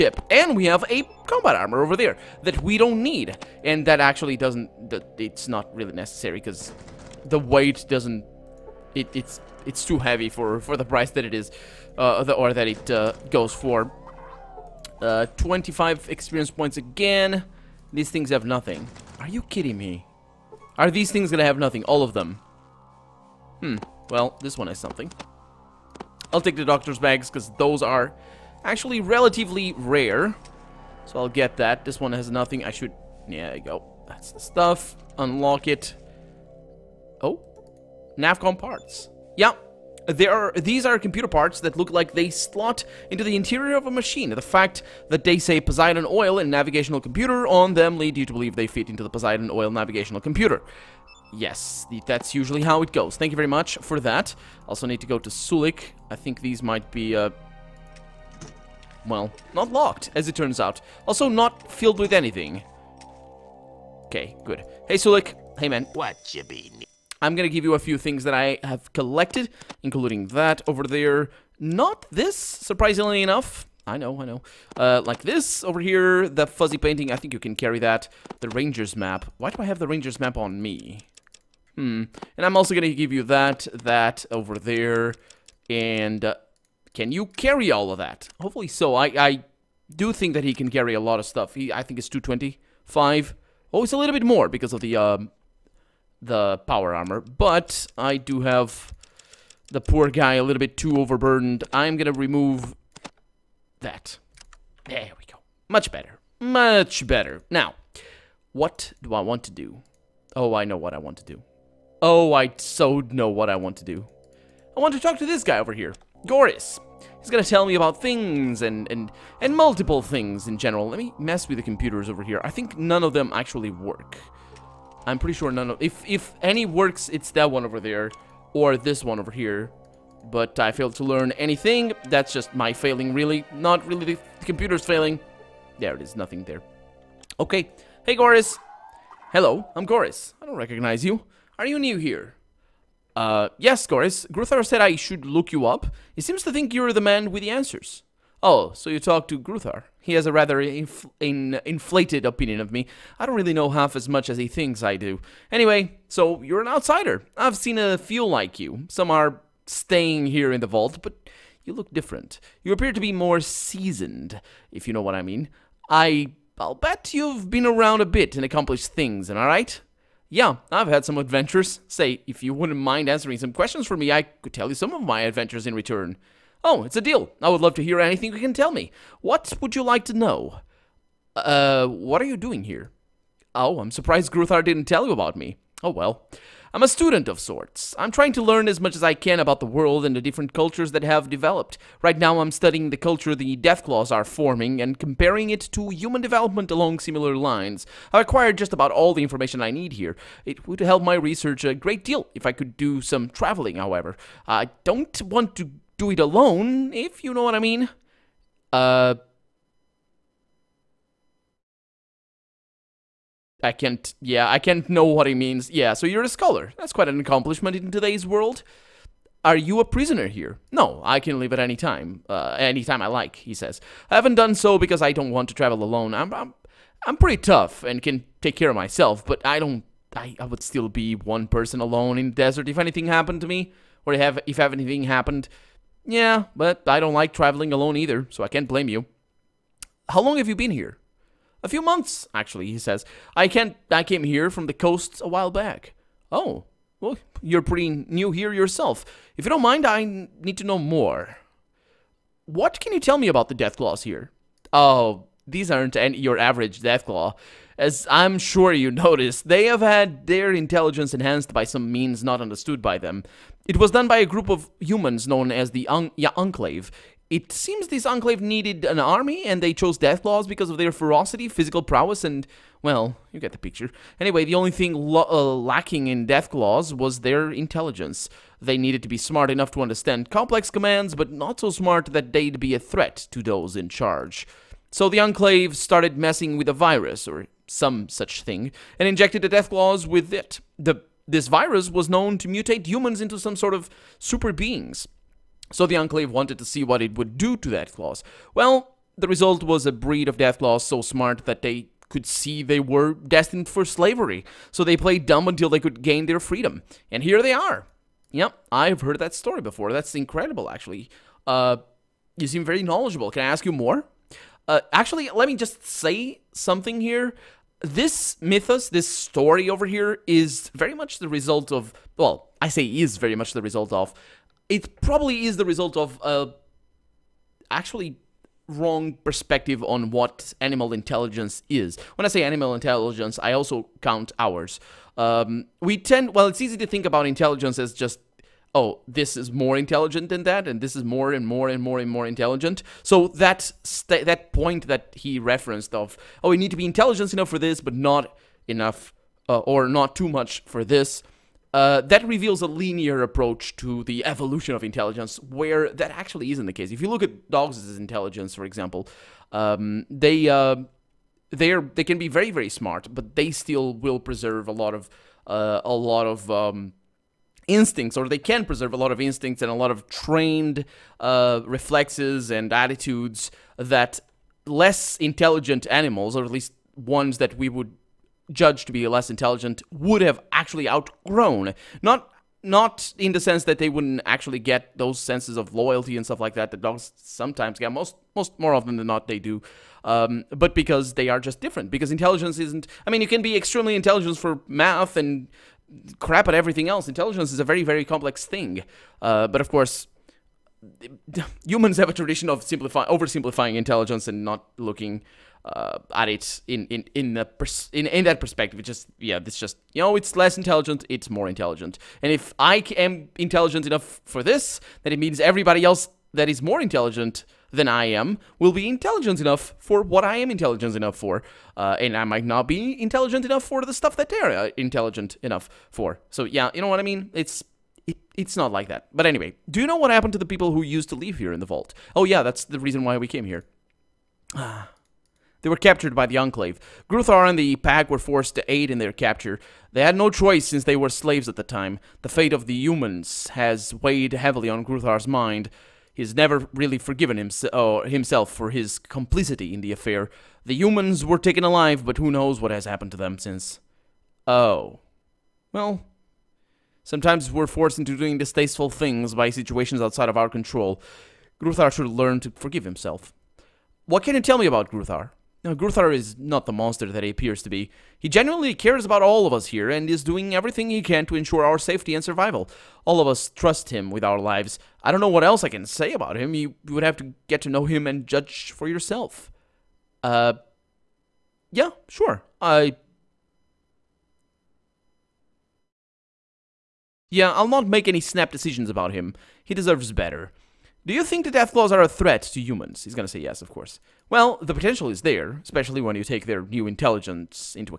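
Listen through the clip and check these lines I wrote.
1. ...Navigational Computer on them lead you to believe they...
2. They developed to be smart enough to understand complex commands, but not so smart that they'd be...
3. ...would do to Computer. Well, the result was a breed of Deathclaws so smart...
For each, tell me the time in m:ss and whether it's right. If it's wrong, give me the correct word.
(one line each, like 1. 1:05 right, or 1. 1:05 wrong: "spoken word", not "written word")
1. 0:46 right
2. 4:38 wrong: "needed", not "developed"
3. 4:57 wrong: "Deathclaws", not "Computer".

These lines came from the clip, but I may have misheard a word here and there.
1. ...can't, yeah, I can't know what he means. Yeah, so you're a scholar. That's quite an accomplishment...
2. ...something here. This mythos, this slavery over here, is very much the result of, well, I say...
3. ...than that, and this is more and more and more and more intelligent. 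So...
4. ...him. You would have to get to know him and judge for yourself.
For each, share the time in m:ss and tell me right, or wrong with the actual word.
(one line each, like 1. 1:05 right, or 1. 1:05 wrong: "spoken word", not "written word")
1. 3:33 right
2. 5:16 wrong: "story", not "slavery"
3. 5:40 right
4. 7:56 right.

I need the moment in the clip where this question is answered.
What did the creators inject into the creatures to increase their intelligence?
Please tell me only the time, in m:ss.
4:46.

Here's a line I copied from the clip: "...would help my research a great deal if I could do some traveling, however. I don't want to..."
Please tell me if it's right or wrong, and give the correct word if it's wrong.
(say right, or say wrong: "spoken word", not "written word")
right.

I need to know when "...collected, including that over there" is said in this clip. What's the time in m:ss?
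1:08.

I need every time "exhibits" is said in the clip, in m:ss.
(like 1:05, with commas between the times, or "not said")
not said.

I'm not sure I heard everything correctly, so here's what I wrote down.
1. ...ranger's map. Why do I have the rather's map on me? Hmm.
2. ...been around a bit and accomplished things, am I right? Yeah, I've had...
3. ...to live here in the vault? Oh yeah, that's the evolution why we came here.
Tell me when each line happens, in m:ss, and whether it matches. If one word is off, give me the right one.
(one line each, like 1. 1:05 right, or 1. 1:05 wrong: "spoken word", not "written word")
1. 1:18 wrong: "ranger", not "rather"
2. 2:47 right
3. 7:11 wrong: "reason", not "evolution".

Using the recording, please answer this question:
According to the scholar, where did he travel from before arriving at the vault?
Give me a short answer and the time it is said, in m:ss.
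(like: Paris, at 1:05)
the coast, at 4:04.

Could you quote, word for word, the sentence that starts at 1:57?
He's gonna tell me about things and, and, and multiple things in general.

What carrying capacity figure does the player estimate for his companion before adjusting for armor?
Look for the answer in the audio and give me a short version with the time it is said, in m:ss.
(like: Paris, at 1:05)
225, at 1:32.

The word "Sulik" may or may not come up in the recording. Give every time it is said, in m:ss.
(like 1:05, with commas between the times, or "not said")
0:55, 1:04.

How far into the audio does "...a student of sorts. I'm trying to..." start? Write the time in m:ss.
3:06.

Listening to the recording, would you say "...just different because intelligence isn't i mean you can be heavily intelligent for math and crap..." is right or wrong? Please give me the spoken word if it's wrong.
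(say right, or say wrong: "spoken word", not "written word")
wrong: "extremely", not "heavily".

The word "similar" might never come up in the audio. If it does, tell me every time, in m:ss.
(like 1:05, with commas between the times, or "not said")
3:16.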